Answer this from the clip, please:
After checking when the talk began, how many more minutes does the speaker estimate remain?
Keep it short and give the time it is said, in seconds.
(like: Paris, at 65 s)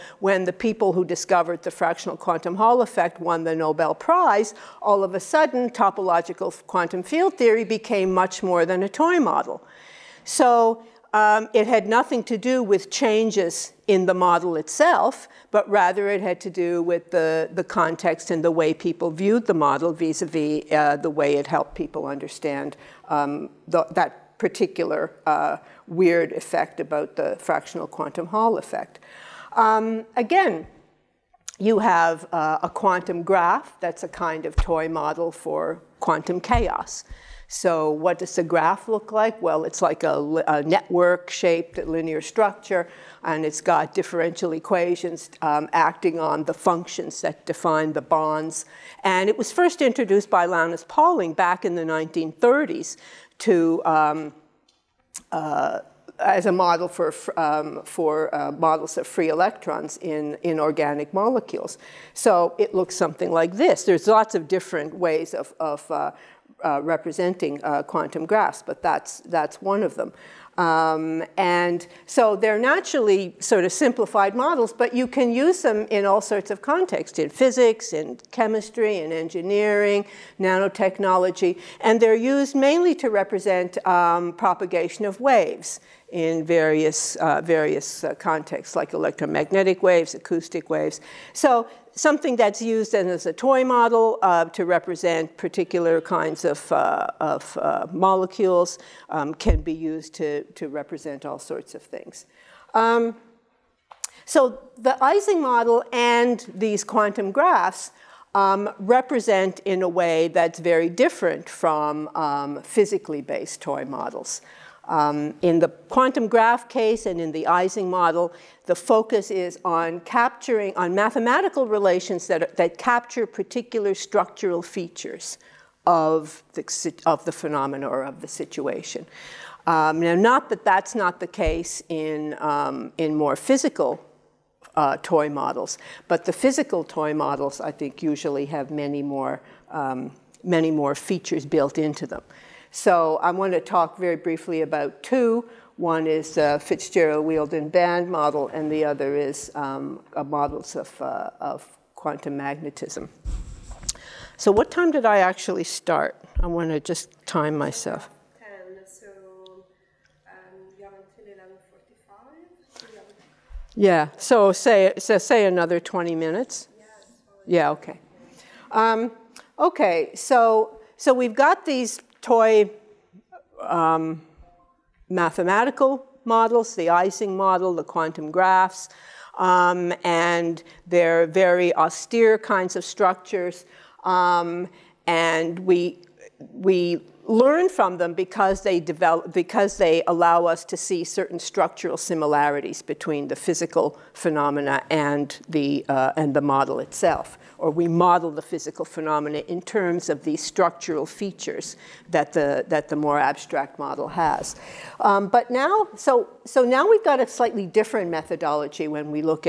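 20 minutes, at 165 s.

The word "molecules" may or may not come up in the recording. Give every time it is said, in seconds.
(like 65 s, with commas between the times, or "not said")
61 s, 97 s.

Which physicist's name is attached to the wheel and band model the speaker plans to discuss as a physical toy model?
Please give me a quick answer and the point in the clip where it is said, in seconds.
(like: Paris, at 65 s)
Fitzgerald, at 146 s.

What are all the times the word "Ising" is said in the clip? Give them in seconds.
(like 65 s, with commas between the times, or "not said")
105 s, 117 s, 176 s.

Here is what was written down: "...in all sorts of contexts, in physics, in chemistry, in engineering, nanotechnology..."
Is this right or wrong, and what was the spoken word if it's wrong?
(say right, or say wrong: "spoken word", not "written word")
right.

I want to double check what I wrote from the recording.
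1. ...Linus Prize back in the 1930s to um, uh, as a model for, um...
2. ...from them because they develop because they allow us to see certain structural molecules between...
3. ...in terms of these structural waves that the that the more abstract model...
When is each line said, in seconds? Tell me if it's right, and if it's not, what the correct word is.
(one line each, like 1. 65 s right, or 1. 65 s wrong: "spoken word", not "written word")
1. 50 s wrong: "Pauling", not "Prize"
2. 187 s wrong: "similarities", not "molecules"
3. 199 s wrong: "features", not "waves".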